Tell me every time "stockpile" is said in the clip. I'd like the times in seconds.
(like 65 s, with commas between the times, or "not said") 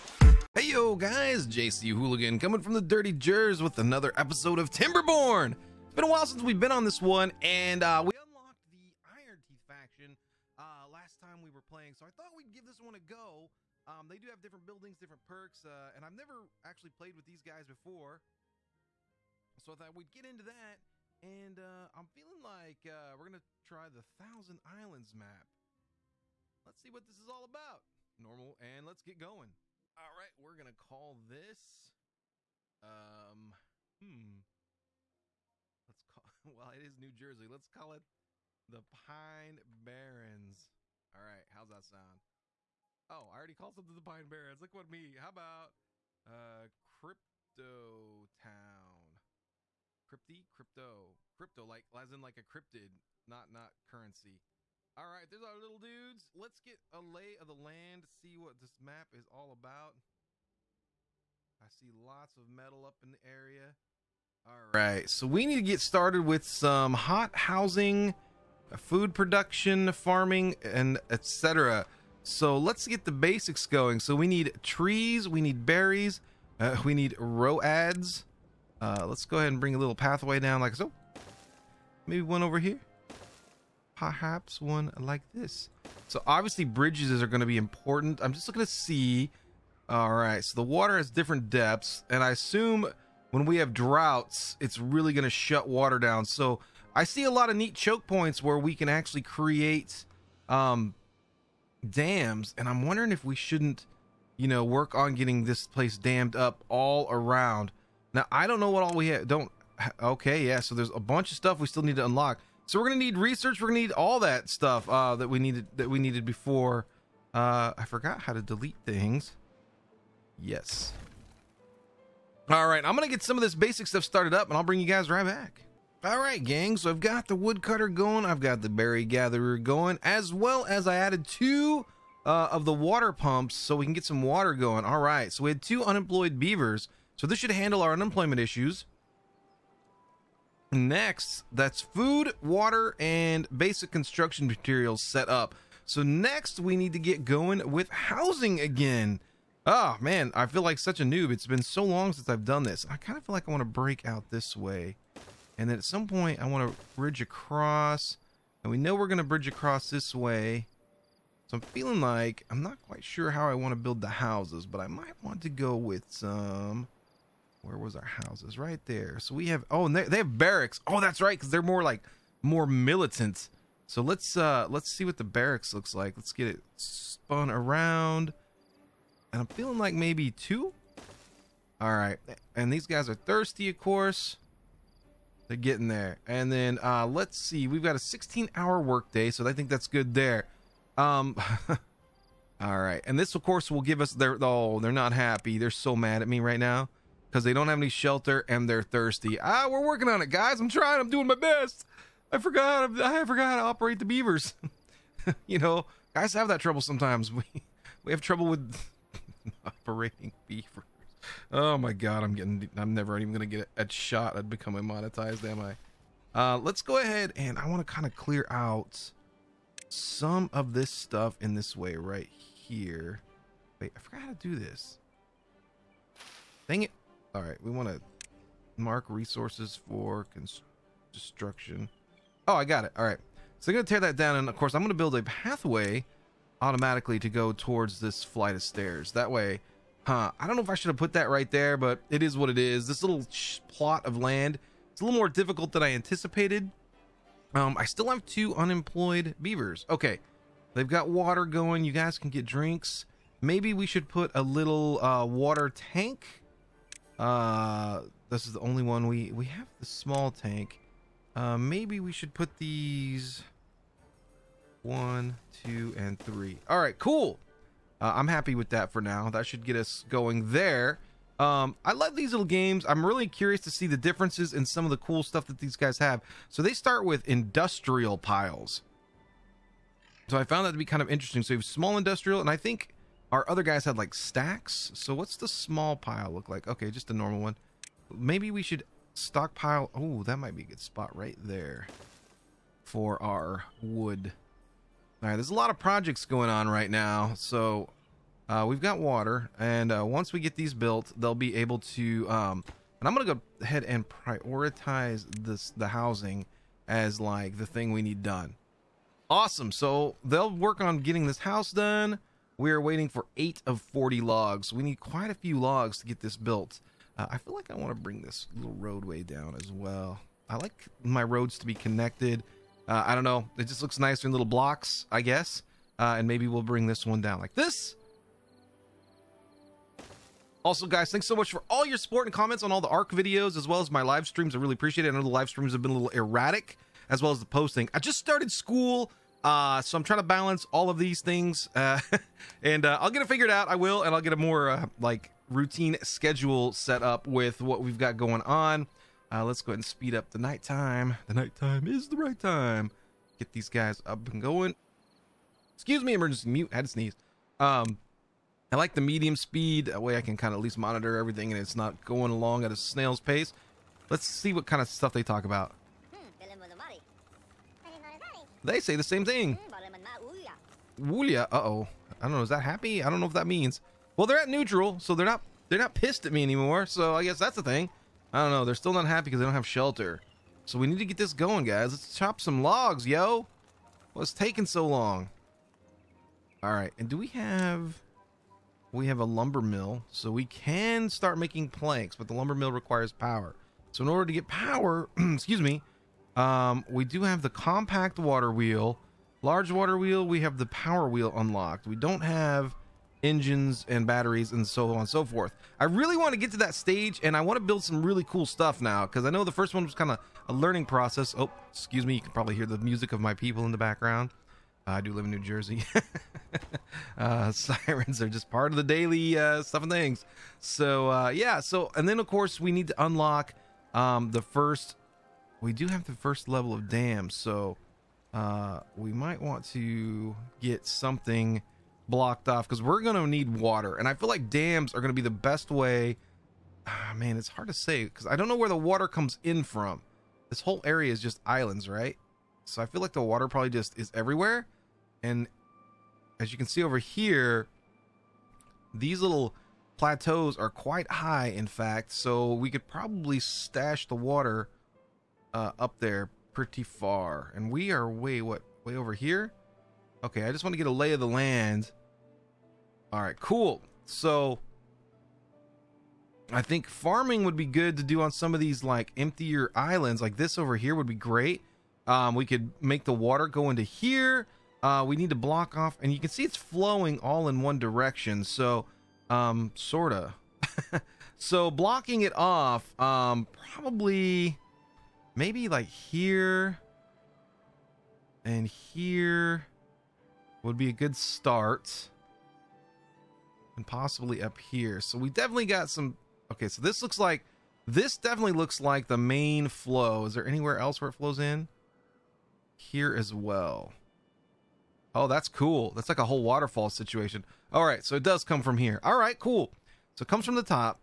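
289 s.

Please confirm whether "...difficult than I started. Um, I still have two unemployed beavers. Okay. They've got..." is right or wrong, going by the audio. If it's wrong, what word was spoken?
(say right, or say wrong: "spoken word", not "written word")
wrong: "anticipated", not "started".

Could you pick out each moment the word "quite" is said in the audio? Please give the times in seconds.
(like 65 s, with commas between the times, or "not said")
162 s, 314 s, 450 s.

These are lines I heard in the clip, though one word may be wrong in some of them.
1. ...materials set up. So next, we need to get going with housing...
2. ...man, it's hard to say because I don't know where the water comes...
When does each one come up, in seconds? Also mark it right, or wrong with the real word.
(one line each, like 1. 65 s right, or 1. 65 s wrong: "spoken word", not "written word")
1. 144 s right
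2. 437 s right.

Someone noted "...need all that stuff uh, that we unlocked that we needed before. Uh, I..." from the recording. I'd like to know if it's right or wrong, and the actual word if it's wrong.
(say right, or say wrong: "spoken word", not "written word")
wrong: "needed", not "unlocked".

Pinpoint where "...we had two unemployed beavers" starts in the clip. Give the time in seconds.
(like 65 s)
135 s.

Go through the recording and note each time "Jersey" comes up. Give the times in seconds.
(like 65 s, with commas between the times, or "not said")
37 s, 415 s.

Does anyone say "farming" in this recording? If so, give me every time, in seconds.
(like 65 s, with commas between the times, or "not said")
69 s, 466 s.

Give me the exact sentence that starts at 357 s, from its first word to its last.
Um, I like the medium speed.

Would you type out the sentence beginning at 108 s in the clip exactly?
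Now I don't know what all we have.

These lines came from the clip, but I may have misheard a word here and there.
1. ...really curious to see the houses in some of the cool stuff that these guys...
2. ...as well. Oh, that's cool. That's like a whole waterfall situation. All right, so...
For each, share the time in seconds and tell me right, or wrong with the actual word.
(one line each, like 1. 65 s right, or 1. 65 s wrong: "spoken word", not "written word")
1. 273 s wrong: "differences", not "houses"
2. 503 s right.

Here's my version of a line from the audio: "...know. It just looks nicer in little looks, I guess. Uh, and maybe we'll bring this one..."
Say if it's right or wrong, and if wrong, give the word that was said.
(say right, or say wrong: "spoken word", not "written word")
wrong: "blocks", not "looks".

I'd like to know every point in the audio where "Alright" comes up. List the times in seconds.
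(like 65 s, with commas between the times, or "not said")
181 s, 192 s.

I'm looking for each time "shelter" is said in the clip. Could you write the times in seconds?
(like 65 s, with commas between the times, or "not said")
197 s, 379 s.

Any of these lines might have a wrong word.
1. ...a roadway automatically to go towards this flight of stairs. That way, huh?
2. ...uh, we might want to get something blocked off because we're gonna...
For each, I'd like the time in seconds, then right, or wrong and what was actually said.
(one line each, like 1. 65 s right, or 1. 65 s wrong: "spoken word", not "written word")
1. 235 s wrong: "pathway", not "roadway"
2. 428 s right.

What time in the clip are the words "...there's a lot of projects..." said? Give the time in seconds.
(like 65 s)
295 s.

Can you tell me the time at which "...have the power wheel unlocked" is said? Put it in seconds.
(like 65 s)
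400 s.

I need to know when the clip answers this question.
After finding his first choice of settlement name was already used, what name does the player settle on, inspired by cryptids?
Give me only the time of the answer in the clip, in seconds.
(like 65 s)
46 s.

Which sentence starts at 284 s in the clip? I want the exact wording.
So what's the small pile look like?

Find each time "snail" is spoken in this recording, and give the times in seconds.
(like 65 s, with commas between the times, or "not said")
362 s.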